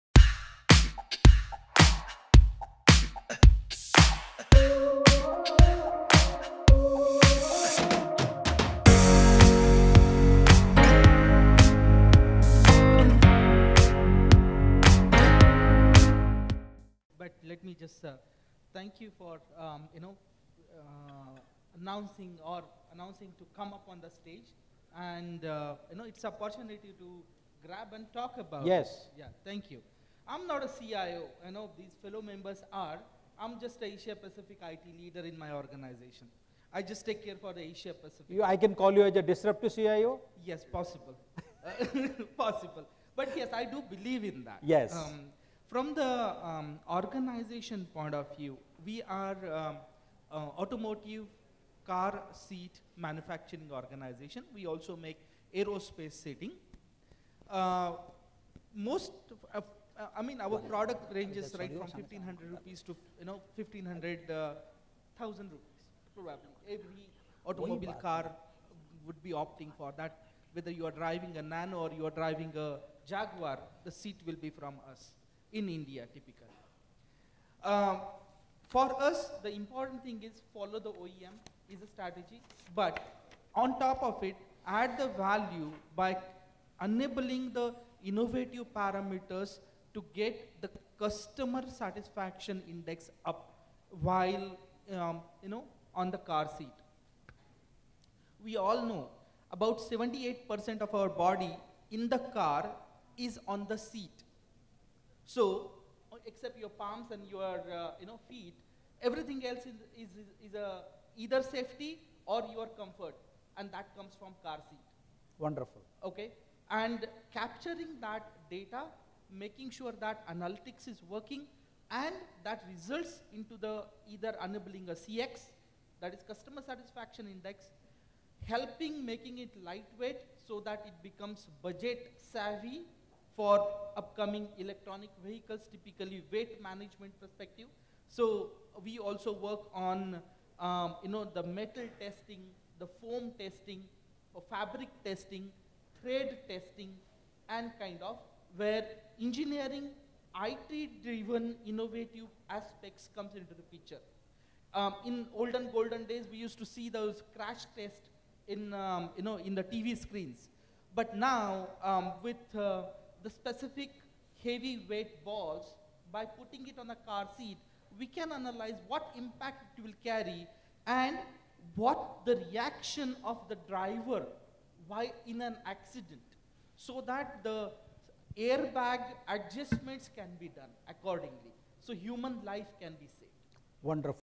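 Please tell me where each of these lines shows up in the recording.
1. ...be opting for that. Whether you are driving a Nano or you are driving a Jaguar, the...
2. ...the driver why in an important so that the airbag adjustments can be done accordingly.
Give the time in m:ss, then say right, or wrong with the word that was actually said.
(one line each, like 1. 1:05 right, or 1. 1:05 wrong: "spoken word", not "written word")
1. 1:09 right
2. 2:53 wrong: "accident", not "important".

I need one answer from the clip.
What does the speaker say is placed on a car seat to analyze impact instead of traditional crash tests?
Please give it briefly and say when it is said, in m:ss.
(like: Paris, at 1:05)
heavy weight balls, at 2:44.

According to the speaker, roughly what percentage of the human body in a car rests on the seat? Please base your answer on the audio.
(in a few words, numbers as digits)
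78%.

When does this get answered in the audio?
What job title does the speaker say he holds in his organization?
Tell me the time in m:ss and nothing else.
0:33.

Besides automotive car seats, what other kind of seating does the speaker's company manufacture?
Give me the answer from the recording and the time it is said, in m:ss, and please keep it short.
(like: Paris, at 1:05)
aerospace seating, at 0:55.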